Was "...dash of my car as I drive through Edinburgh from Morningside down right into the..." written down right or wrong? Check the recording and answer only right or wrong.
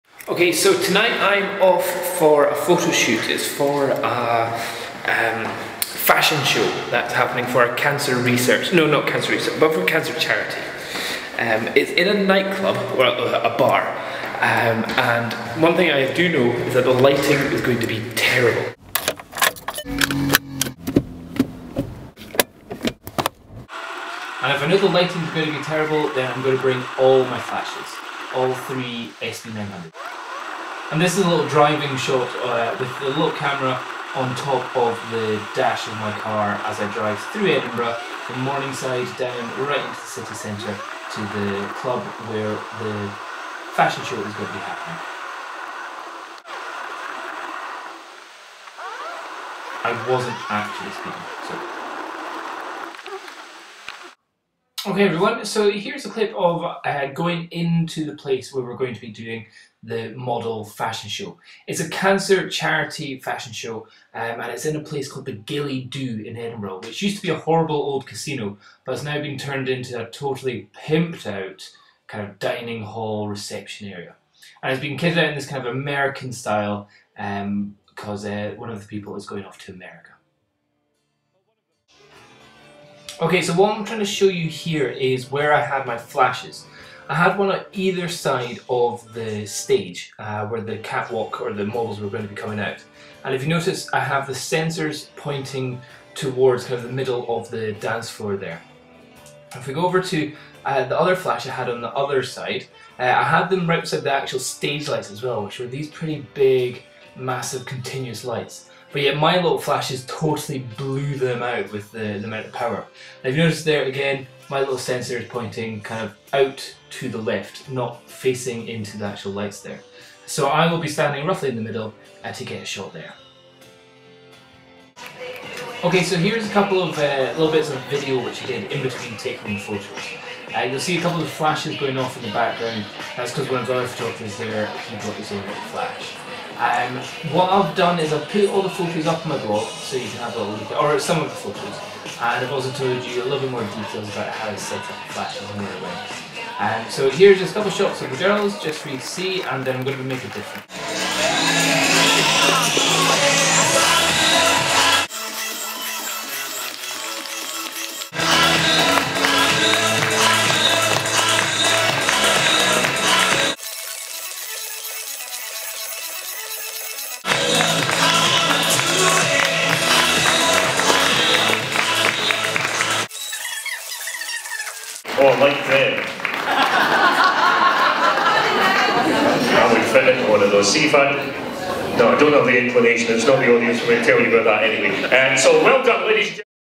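right.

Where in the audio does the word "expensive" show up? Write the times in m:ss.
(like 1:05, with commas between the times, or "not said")
not said.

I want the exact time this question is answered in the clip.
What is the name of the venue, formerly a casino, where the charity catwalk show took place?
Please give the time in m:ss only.
1:05.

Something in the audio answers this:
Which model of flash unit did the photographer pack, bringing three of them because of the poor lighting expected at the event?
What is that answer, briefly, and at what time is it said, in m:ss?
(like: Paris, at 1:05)
SB900, at 0:29.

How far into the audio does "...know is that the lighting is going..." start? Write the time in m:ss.
0:16.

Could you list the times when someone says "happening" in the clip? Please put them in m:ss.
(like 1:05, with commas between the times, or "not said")
0:07, 0:44.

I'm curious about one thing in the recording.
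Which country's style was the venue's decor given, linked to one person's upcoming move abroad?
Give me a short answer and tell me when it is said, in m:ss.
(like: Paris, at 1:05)
American, at 1:15.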